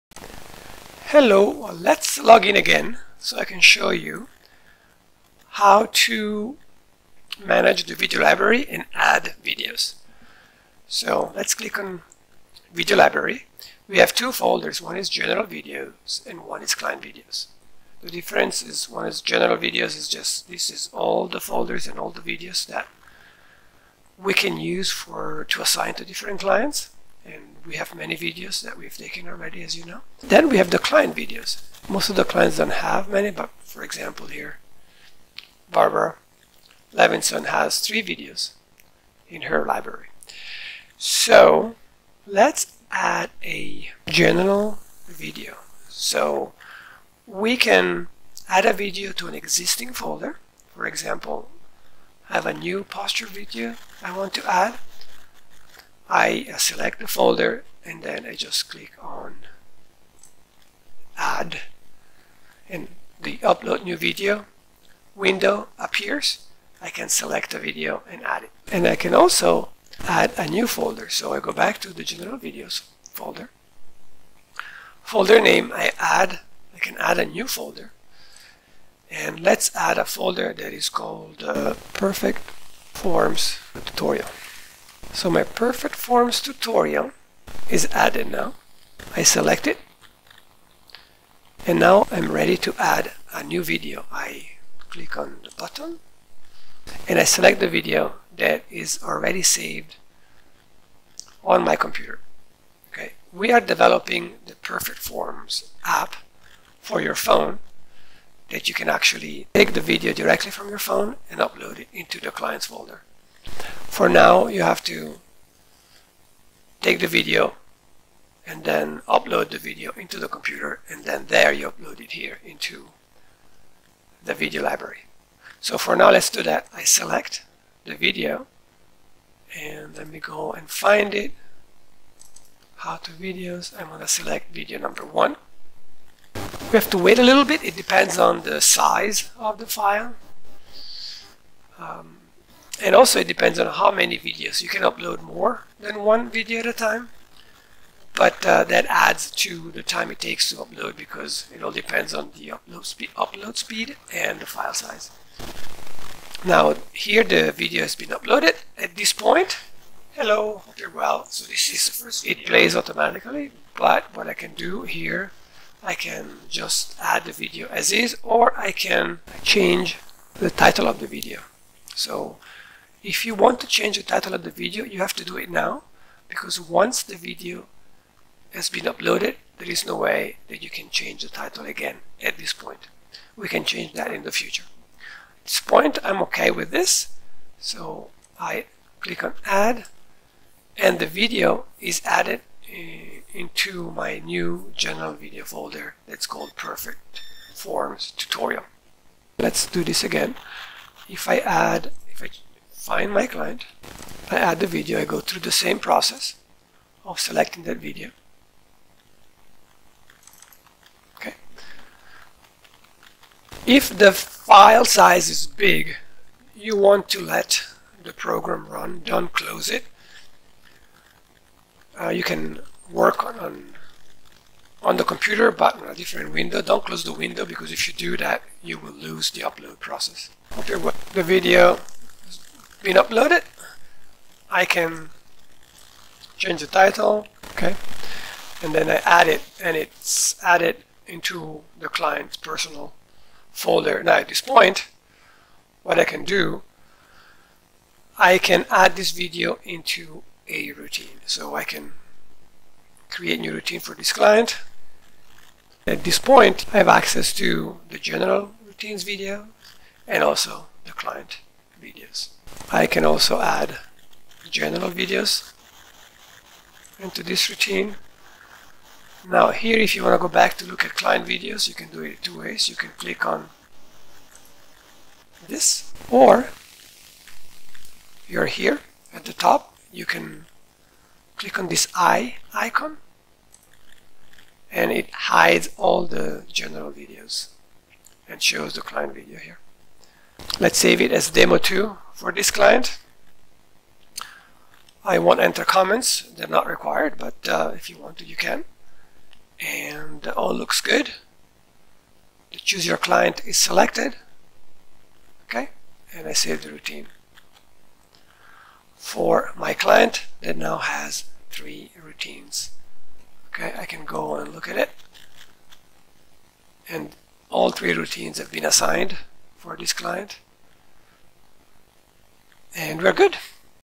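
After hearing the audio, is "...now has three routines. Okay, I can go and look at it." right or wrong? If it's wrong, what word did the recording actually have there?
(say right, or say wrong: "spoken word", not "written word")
right.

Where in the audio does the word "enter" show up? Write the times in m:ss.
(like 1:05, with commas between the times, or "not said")
4:55.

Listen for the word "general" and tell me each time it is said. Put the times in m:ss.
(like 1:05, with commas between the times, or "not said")
0:15, 0:19, 0:44, 1:12, 3:14, 4:17, 4:24, 4:46.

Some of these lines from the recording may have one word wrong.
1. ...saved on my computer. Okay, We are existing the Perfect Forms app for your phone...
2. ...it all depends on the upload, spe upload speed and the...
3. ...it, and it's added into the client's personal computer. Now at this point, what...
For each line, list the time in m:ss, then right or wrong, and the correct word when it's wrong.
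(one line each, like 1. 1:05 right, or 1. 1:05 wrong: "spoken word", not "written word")
1. 1:39 wrong: "developing", not "existing"
2. 2:31 right
3. 3:59 wrong: "folder", not "computer".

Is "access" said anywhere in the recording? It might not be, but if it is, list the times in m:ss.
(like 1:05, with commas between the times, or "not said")
4:16.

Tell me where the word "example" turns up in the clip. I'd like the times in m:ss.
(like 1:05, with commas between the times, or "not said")
0:33, 0:50.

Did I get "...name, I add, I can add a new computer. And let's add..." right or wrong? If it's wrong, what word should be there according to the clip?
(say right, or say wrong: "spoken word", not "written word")
wrong: "folder", not "computer".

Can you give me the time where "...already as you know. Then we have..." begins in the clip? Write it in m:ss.
0:29.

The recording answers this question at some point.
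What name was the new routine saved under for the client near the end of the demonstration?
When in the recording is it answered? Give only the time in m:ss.
4:51.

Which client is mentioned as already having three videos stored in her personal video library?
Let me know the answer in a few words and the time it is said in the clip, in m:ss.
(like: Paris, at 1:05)
Barbara Levinson, at 0:35.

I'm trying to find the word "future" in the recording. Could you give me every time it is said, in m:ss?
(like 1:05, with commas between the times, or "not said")
3:04.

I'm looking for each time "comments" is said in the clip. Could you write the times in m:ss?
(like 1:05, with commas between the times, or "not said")
4:55.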